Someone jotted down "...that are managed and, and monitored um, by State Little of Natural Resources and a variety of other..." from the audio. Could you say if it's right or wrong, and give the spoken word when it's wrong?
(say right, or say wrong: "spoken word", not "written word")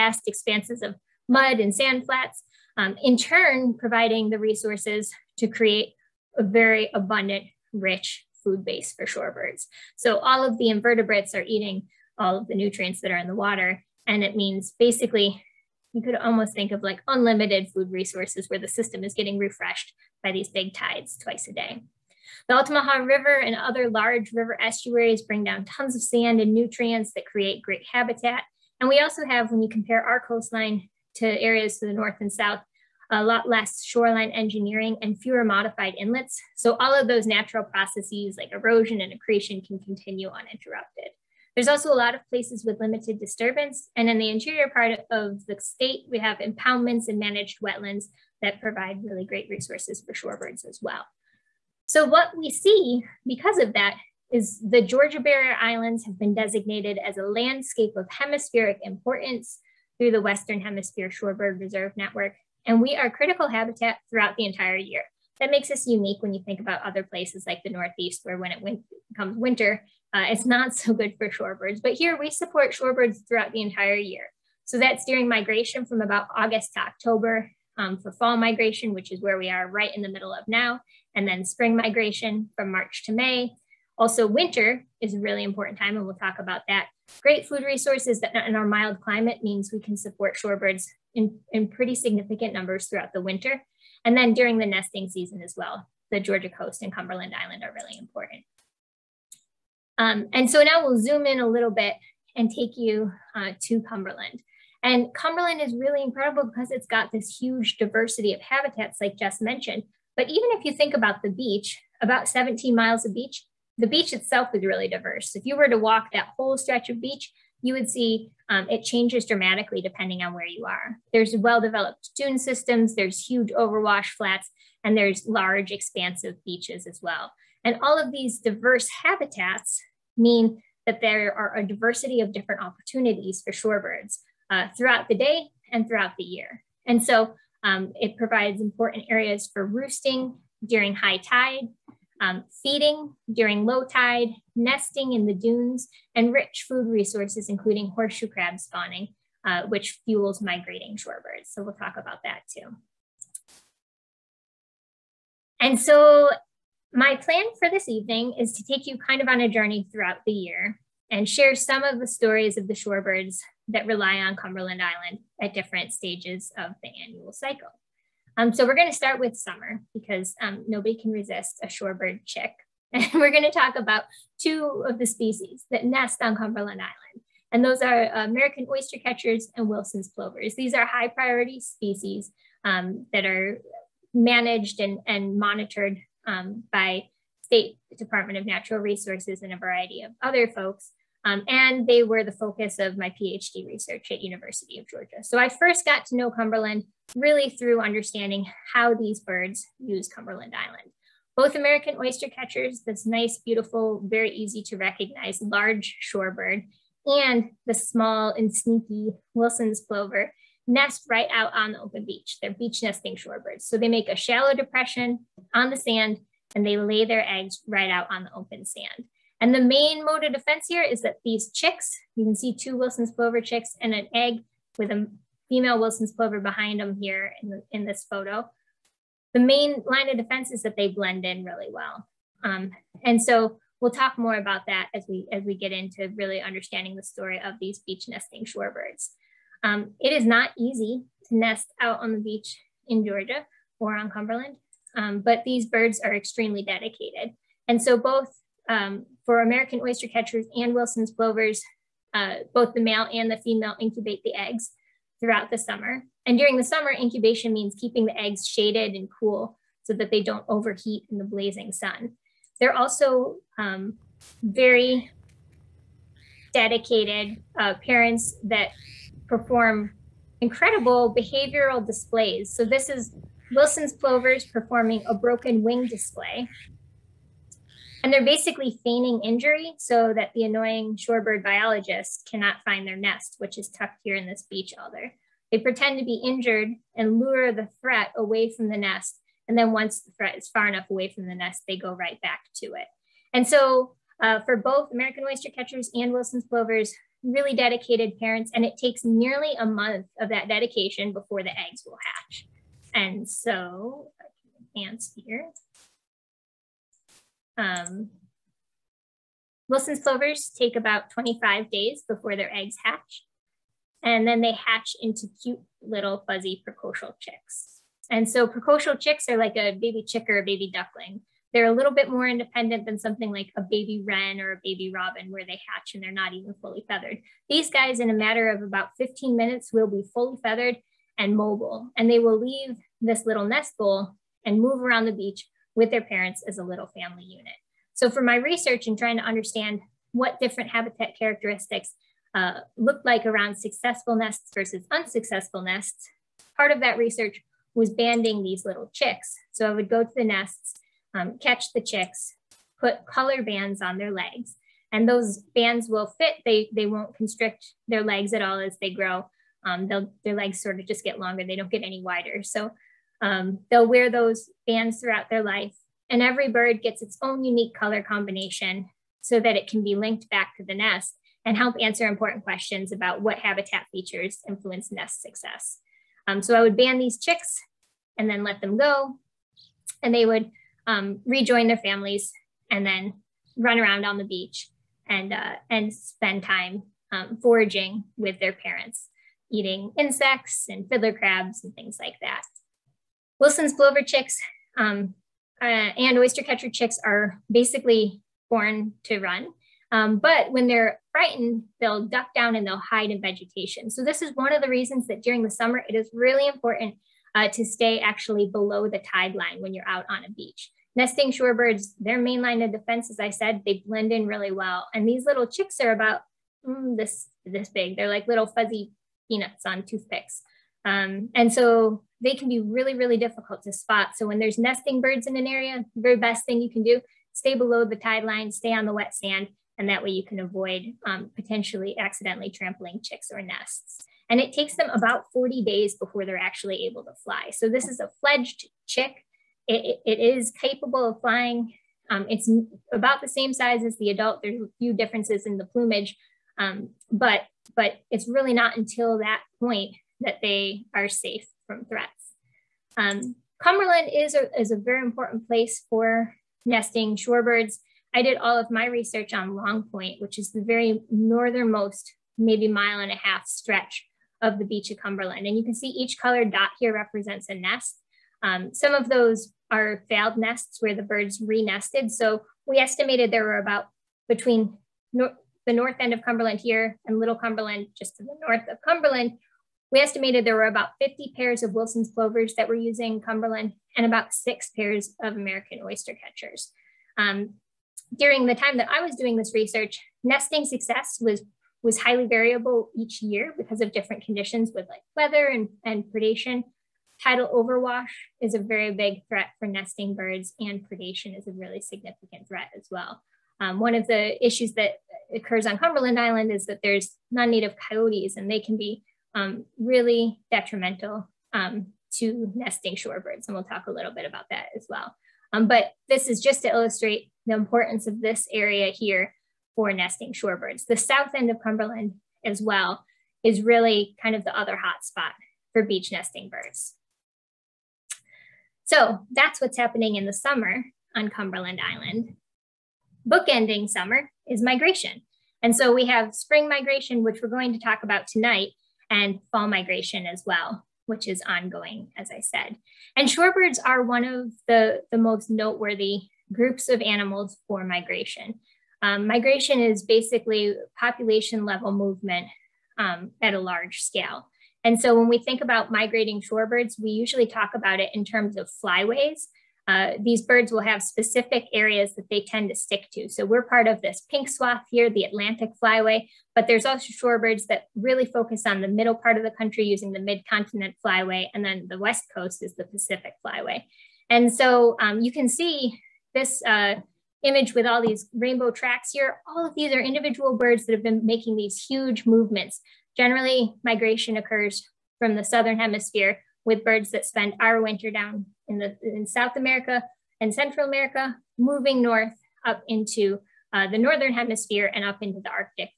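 wrong: "Department", not "Little".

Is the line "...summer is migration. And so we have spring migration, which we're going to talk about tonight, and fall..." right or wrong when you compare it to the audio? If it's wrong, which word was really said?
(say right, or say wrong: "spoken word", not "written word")
right.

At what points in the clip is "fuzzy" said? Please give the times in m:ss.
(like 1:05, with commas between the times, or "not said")
5:16, 6:58.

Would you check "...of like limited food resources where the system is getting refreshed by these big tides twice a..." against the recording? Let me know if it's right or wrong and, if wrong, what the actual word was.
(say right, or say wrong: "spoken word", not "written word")
wrong: "unlimited", not "limited".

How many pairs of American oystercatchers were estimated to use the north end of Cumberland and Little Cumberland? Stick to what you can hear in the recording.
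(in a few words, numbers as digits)
6.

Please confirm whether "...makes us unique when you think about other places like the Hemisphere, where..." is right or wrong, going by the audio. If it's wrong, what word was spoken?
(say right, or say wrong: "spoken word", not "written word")
wrong: "Northeast", not "Hemisphere".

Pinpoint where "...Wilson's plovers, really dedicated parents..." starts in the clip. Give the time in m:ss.
4:56.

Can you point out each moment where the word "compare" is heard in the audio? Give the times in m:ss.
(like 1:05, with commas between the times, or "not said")
0:29.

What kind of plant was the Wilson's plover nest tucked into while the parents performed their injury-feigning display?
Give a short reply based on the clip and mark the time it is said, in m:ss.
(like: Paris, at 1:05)
beach alder, at 4:44.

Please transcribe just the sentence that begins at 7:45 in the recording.
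And you can see each colored dot here represents a nest.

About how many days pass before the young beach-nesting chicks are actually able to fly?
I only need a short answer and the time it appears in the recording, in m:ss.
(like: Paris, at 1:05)
40, at 7:15.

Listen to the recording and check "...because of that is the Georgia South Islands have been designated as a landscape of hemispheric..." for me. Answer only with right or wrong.
wrong.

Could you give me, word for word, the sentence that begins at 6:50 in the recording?
Nesting shorebirds, their main line of defense, as I said, they blend in really well.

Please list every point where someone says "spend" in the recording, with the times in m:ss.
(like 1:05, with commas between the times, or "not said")
6:25, 9:47.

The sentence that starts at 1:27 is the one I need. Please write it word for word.
Great food resources that in our mild climate means we can support shorebirds in, in pretty significant numbers throughout the winter.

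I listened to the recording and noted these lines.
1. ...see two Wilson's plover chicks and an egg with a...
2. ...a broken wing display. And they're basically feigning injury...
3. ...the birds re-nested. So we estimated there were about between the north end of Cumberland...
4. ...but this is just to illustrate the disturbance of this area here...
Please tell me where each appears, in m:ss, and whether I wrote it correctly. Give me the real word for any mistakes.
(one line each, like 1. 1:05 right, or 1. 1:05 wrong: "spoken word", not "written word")
1. 3:42 right
2. 4:35 right
3. 7:50 right
4. 8:35 wrong: "importance", not "disturbance".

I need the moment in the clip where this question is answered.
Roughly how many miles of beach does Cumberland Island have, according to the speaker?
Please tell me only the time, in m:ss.
1:52.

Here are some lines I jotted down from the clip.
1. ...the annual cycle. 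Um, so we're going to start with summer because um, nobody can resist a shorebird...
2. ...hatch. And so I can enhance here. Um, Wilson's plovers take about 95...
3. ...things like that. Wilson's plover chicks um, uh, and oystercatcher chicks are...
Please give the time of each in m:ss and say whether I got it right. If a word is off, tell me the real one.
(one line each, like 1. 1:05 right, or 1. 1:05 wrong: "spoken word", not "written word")
1. 2:46 right
2. 5:02 wrong: "25", not "95"
3. 6:31 right.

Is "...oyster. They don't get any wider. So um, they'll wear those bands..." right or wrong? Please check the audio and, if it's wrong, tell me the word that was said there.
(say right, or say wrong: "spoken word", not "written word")
wrong: "longer", not "oyster".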